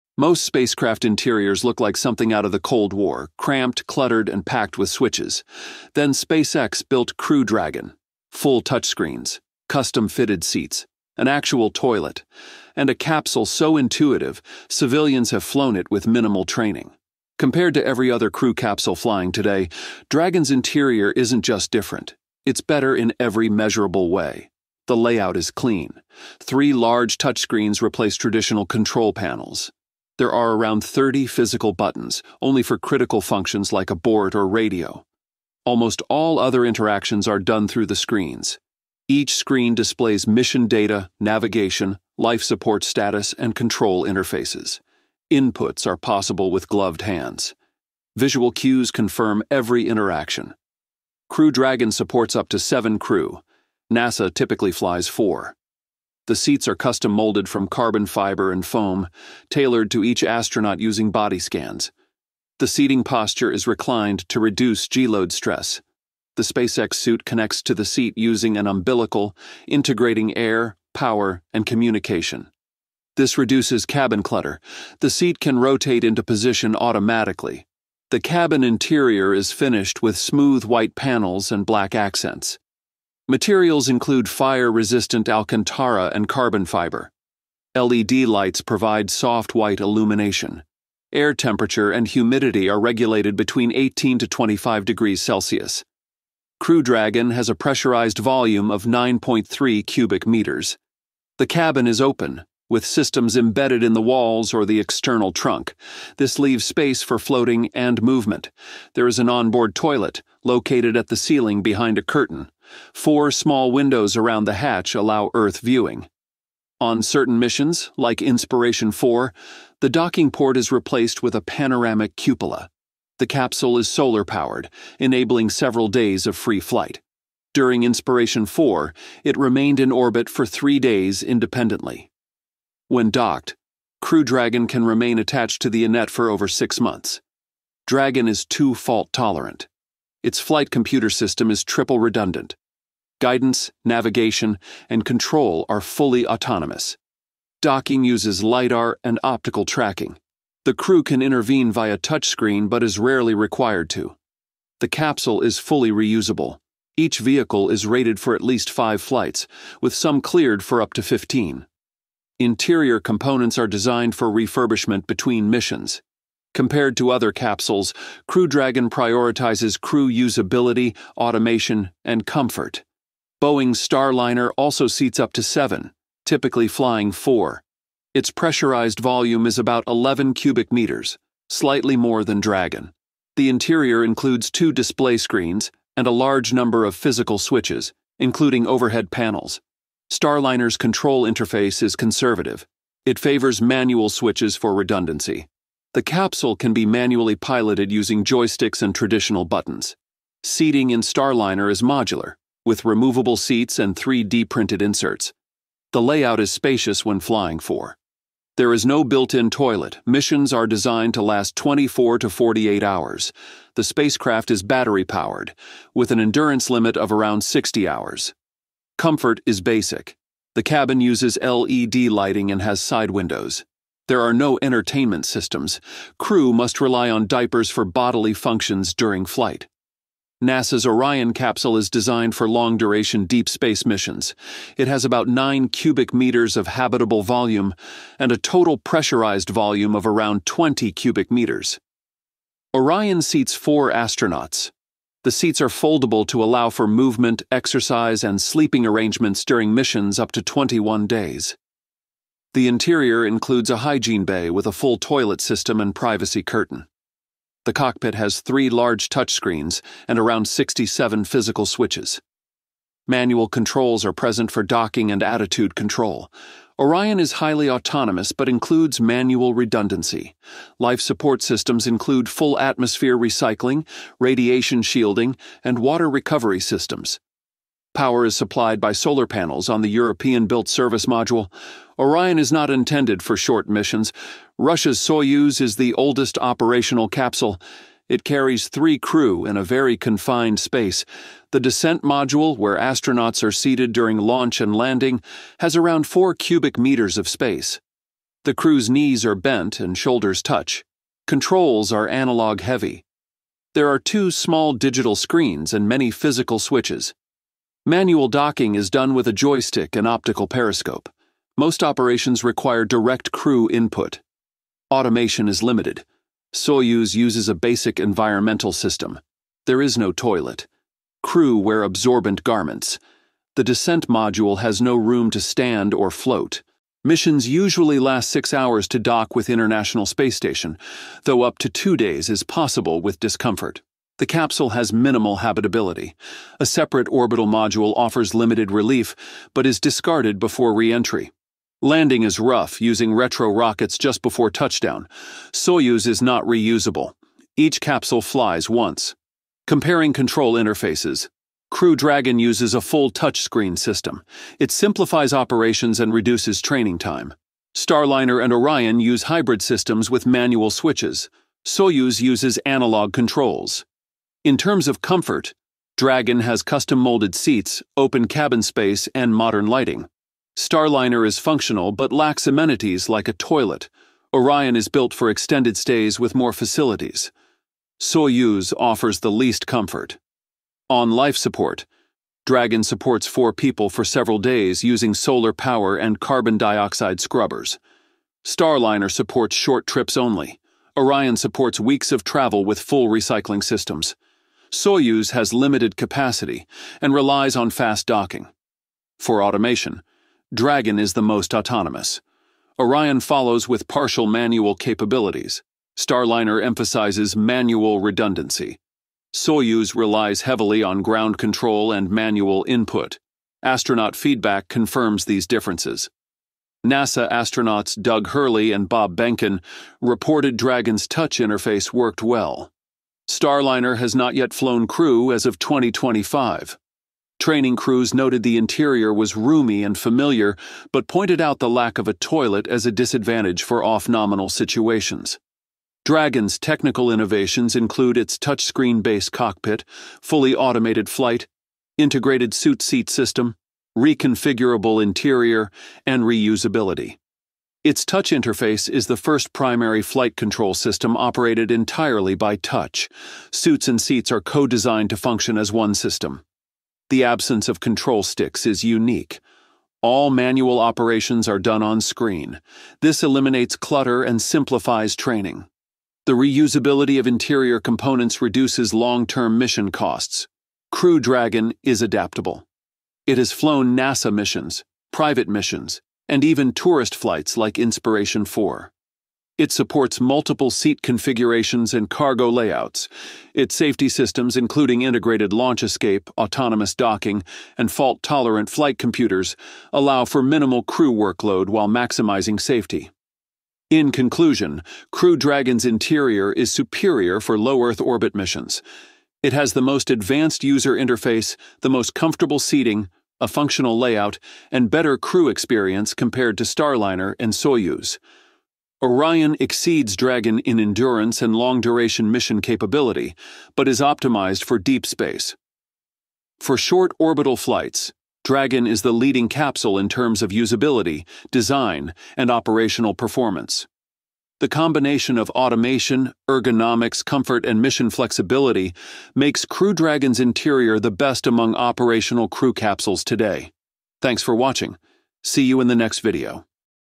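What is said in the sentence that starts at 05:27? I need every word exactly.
Missions usually last six hours to dock with International Space Station, though up to two days is possible with discomfort.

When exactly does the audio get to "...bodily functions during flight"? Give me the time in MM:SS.
03:47.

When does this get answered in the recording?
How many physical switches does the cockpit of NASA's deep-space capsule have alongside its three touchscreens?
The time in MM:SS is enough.
04:20.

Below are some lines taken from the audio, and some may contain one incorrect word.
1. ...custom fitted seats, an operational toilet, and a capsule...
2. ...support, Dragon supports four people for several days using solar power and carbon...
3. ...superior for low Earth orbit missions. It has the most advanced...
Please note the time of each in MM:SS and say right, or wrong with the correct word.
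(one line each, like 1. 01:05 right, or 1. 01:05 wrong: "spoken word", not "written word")
1. 00:09 wrong: "actual", not "operational"
2. 06:21 right
3. 08:16 right.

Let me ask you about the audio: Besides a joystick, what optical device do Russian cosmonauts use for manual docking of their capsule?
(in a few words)
optical periscope.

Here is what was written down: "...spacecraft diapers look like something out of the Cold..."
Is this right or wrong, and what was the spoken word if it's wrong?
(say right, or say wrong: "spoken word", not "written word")
wrong: "interiors", not "diapers".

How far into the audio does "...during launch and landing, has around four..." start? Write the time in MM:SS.
04:53.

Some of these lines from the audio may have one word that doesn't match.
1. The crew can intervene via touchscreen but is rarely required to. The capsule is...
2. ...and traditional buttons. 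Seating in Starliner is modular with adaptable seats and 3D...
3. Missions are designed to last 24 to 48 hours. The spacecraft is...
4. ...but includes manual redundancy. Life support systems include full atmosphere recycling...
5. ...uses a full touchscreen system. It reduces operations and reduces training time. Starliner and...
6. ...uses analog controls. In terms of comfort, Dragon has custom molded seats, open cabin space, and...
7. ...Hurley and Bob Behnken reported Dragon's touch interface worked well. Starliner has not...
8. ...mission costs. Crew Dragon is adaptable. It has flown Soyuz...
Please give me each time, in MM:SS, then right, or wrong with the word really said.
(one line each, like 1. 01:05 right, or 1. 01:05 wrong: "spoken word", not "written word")
1. 02:30 right
2. 03:18 wrong: "removable", not "adaptable"
3. 03:30 right
4. 04:28 right
5. 05:52 wrong: "simplifies", not "reduces"
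6. 06:02 right
7. 06:58 right
8. 07:49 wrong: "NASA", not "Soyuz".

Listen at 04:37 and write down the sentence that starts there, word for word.
Power is supplied by solar panels on the European built service module, Orion is not intended for short missions.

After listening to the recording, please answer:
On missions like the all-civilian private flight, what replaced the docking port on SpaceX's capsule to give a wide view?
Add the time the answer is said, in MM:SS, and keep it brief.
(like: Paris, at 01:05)
panoramic cupola, at 02:01.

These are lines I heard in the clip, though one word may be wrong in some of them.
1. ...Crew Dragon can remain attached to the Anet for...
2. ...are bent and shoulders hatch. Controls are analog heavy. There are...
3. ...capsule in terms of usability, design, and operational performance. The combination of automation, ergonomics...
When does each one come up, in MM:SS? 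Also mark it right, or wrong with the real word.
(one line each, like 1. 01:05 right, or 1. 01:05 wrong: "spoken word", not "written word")
1. 02:14 right
2. 04:59 wrong: "touch", not "hatch"
3. 08:39 right.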